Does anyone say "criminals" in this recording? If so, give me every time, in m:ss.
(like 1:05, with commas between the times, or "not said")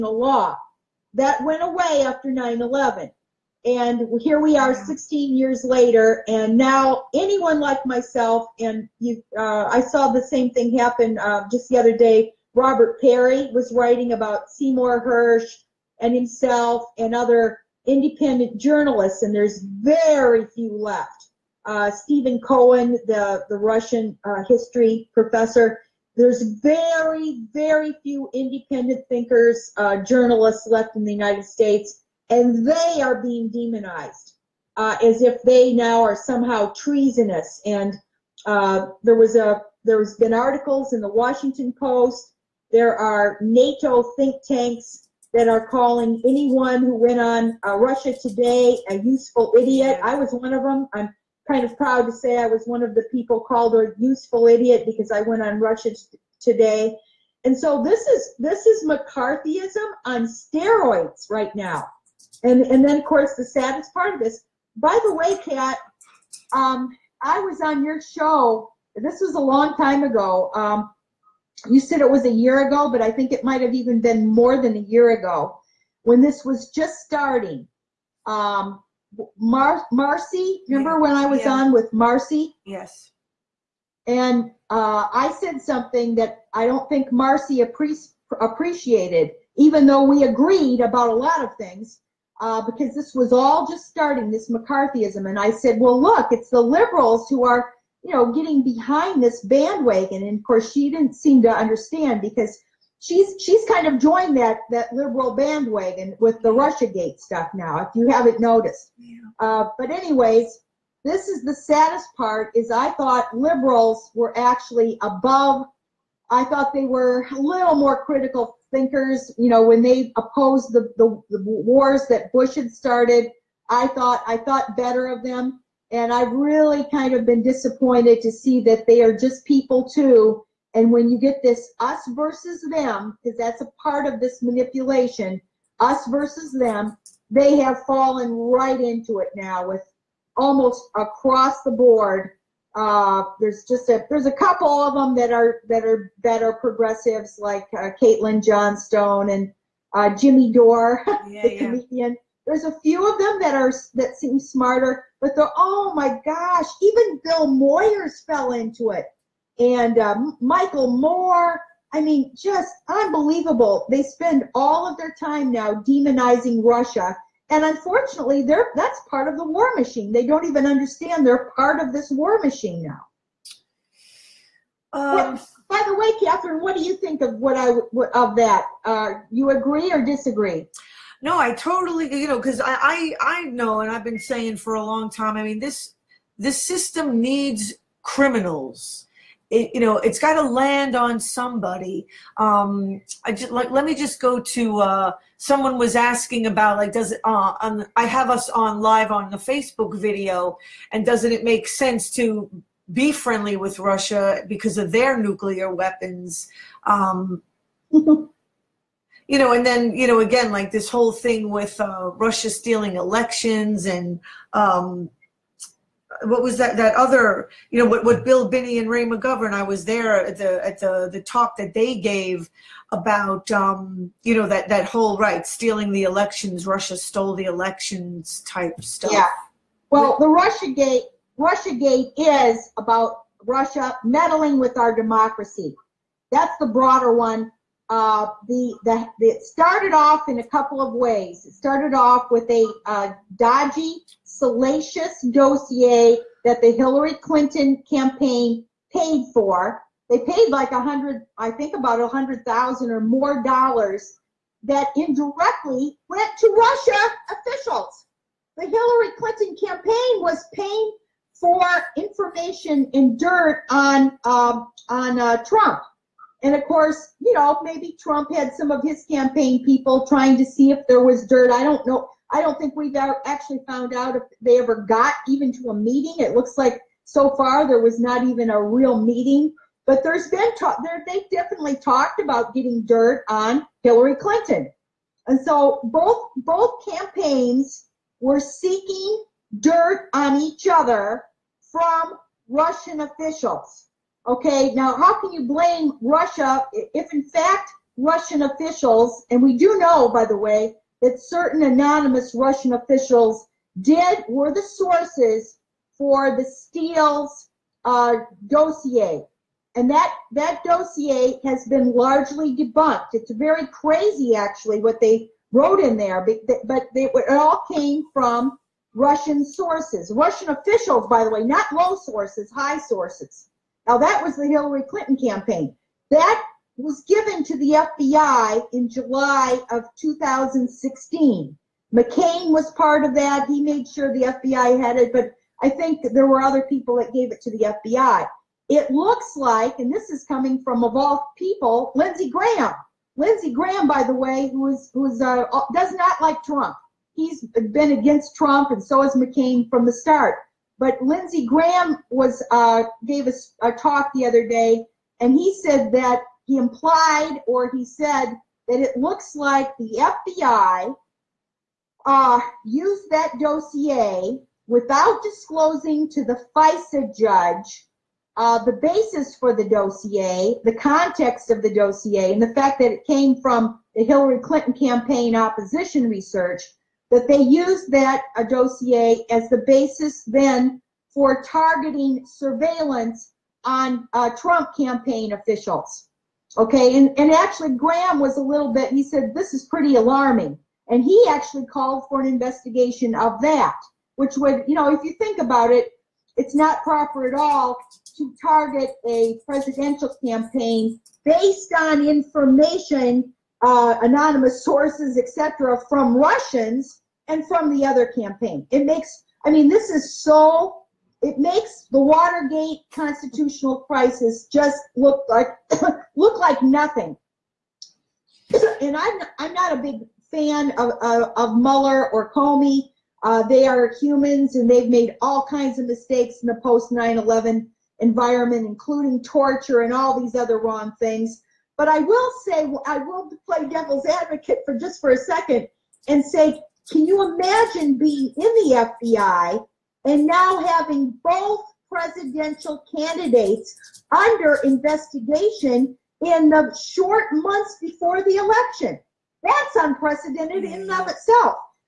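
3:08.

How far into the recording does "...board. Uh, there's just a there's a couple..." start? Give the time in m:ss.
2:21.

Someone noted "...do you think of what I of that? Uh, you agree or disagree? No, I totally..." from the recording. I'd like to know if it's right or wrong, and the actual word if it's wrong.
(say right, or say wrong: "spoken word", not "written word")
right.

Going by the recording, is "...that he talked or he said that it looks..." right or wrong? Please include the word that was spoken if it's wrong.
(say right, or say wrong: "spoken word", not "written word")
wrong: "implied", not "talked".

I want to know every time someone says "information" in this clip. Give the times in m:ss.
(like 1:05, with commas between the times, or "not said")
4:21, 6:42.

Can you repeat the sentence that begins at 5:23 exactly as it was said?
Now, that was the Hillary Clinton campaign.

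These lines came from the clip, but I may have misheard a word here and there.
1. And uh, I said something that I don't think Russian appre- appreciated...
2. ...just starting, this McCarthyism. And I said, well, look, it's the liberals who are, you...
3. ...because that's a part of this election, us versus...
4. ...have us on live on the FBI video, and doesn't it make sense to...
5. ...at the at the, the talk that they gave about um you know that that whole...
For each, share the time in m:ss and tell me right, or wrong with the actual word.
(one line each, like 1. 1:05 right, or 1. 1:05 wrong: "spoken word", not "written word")
1. 1:24 wrong: "Marcy", not "Russian"
2. 1:33 right
3. 2:13 wrong: "manipulation", not "election"
4. 3:18 wrong: "Facebook", not "FBI"
5. 3:40 right.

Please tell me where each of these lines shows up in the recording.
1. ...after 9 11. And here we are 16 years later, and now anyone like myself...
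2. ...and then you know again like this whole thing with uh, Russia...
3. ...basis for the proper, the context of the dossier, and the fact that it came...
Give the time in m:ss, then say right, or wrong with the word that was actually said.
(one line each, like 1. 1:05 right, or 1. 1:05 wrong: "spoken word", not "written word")
1. 0:02 right
2. 3:29 right
3. 6:08 wrong: "dossier", not "proper".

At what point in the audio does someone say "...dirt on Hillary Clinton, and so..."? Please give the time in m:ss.
4:42.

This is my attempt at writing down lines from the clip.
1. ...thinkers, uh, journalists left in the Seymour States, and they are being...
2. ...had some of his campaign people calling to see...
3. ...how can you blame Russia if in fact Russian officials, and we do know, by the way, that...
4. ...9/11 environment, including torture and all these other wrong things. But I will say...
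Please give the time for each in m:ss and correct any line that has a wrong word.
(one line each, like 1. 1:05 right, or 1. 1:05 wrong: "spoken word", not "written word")
1. 0:29 wrong: "United", not "Seymour"
2. 4:28 wrong: "trying", not "calling"
3. 4:54 right
4. 7:06 right.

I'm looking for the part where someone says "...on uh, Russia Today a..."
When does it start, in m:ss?
0:47.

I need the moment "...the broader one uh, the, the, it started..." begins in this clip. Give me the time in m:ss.
3:56.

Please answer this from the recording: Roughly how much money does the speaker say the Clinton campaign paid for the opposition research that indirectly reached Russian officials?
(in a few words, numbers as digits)
$100,000.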